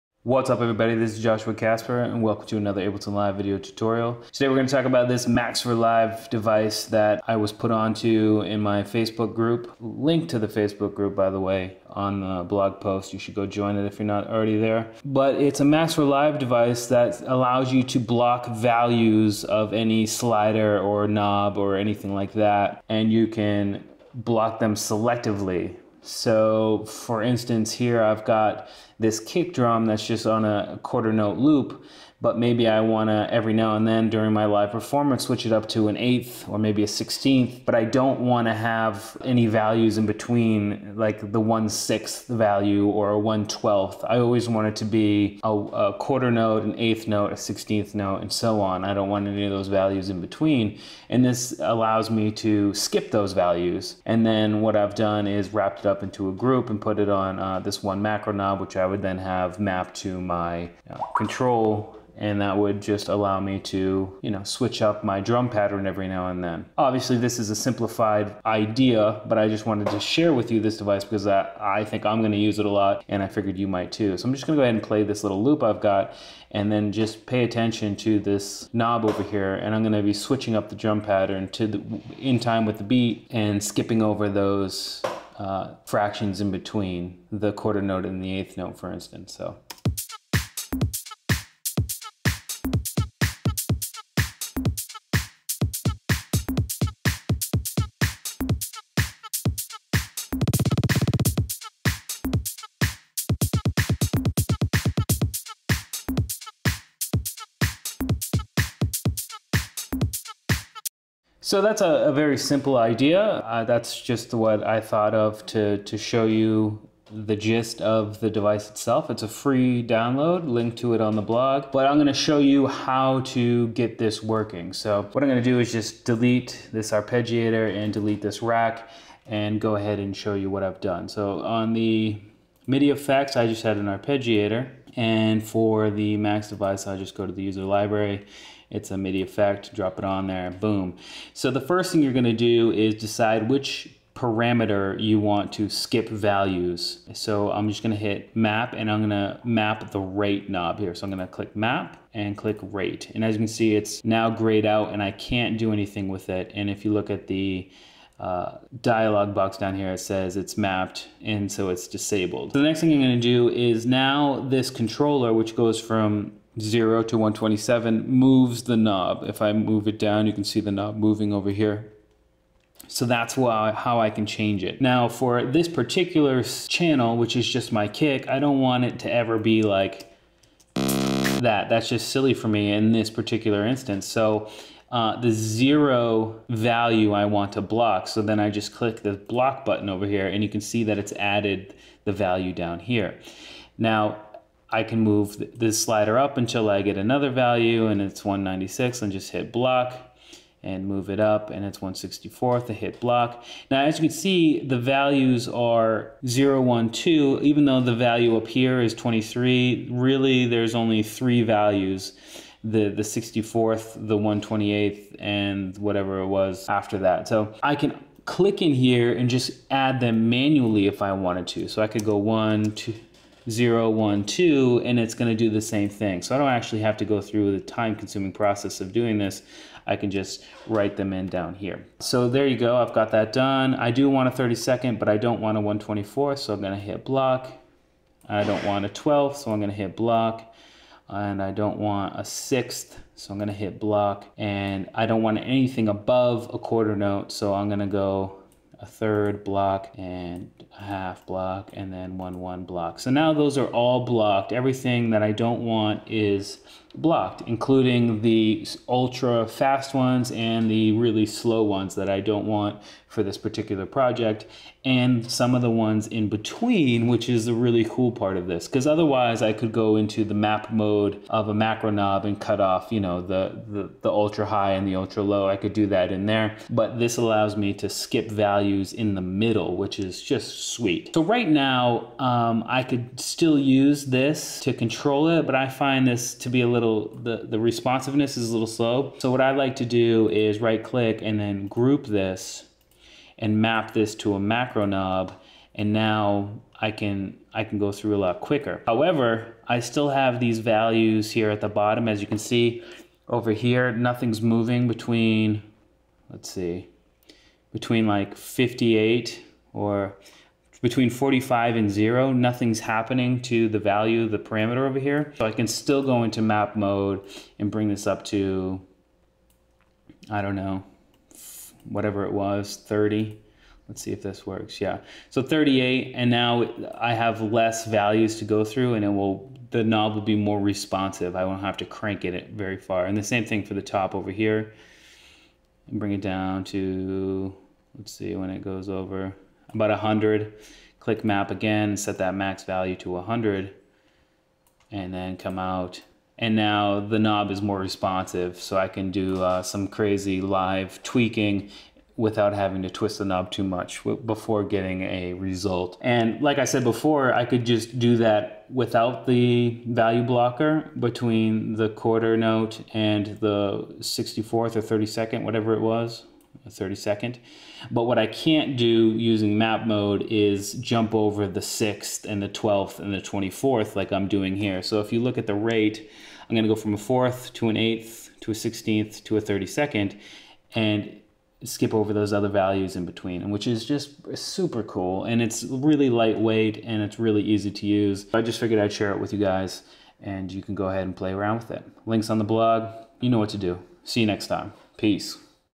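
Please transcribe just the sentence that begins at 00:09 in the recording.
Link to the Facebook group by the way on the blog post.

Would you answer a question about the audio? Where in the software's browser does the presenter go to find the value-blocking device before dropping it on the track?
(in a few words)
User library.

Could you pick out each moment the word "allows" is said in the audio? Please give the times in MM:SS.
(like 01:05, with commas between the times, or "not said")
00:17, 00:51, 01:03, 04:37.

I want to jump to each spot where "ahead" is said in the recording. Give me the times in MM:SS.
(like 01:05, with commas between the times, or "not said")
01:14, 02:09, 06:30.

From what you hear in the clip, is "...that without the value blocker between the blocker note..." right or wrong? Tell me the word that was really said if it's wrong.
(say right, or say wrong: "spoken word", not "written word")
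wrong: "quarter", not "blocker".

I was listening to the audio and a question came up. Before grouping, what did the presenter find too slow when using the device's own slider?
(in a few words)
Responsiveness.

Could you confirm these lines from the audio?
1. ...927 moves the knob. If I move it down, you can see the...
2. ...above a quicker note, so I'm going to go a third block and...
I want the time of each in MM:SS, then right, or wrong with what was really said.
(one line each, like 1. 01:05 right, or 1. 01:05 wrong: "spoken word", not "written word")
1. 02:47 wrong: "127", not "927"
2. 04:05 wrong: "quarter", not "quicker".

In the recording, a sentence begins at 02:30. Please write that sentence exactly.
So I'm gonna click map and click rate.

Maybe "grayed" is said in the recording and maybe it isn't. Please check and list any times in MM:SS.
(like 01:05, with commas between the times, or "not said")
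02:34.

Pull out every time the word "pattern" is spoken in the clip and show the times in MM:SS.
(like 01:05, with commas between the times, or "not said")
01:05, 01:21.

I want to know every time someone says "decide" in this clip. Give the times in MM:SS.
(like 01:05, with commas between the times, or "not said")
02:22.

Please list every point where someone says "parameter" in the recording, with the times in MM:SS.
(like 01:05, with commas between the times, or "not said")
02:24, 05:14.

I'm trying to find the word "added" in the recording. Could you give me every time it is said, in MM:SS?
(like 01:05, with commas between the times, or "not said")
03:11.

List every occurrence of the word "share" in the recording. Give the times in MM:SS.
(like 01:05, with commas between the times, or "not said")
01:09, 06:28.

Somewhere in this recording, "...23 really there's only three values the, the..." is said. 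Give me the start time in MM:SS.
03:28.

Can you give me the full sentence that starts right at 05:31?
I won't have to crank it very far.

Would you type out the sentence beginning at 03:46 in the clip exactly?
So I don't actually have to go through the time-consuming process of doing this.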